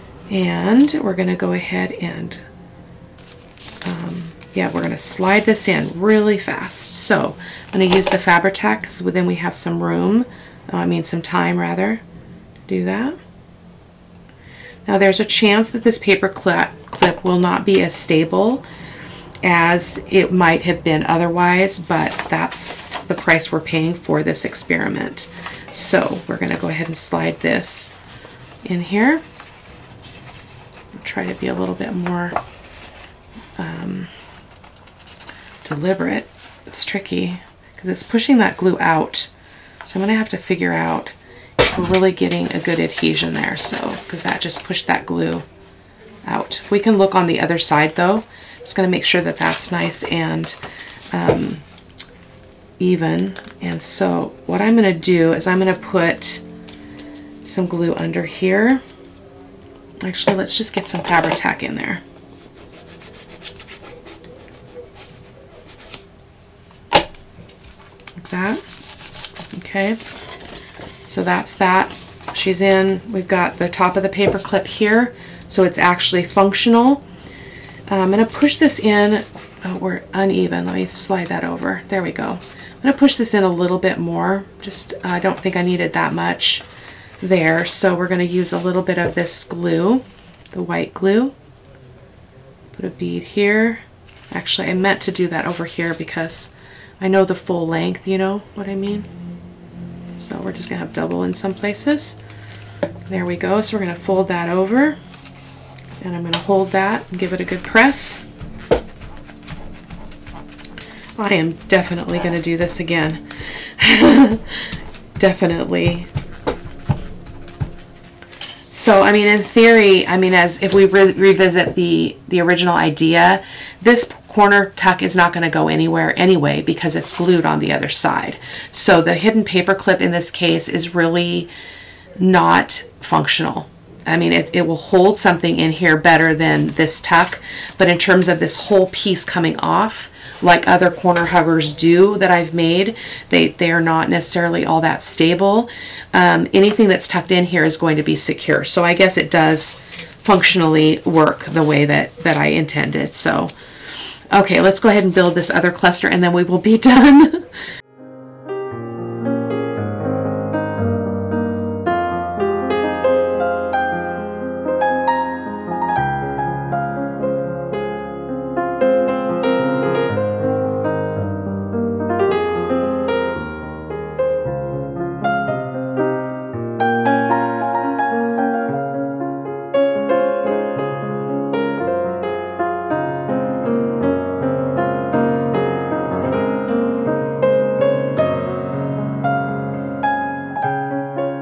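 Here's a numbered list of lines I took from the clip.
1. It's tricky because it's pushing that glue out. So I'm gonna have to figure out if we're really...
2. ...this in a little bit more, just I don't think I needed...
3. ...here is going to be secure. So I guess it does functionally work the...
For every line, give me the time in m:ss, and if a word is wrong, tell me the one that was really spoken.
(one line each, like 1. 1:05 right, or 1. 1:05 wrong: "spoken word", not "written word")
1. 0:36 right
2. 1:23 right
3. 2:27 right.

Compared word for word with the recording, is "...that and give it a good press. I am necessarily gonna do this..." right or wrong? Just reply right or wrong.
wrong.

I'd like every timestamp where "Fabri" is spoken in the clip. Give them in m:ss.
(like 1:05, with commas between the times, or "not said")
0:08, 1:01.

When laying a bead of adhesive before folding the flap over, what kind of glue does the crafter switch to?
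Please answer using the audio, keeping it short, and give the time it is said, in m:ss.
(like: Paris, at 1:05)
white glue, at 1:30.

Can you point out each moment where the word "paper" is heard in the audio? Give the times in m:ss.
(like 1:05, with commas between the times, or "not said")
0:15, 1:14, 2:09.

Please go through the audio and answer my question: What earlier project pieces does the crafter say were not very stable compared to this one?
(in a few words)
corner huggers.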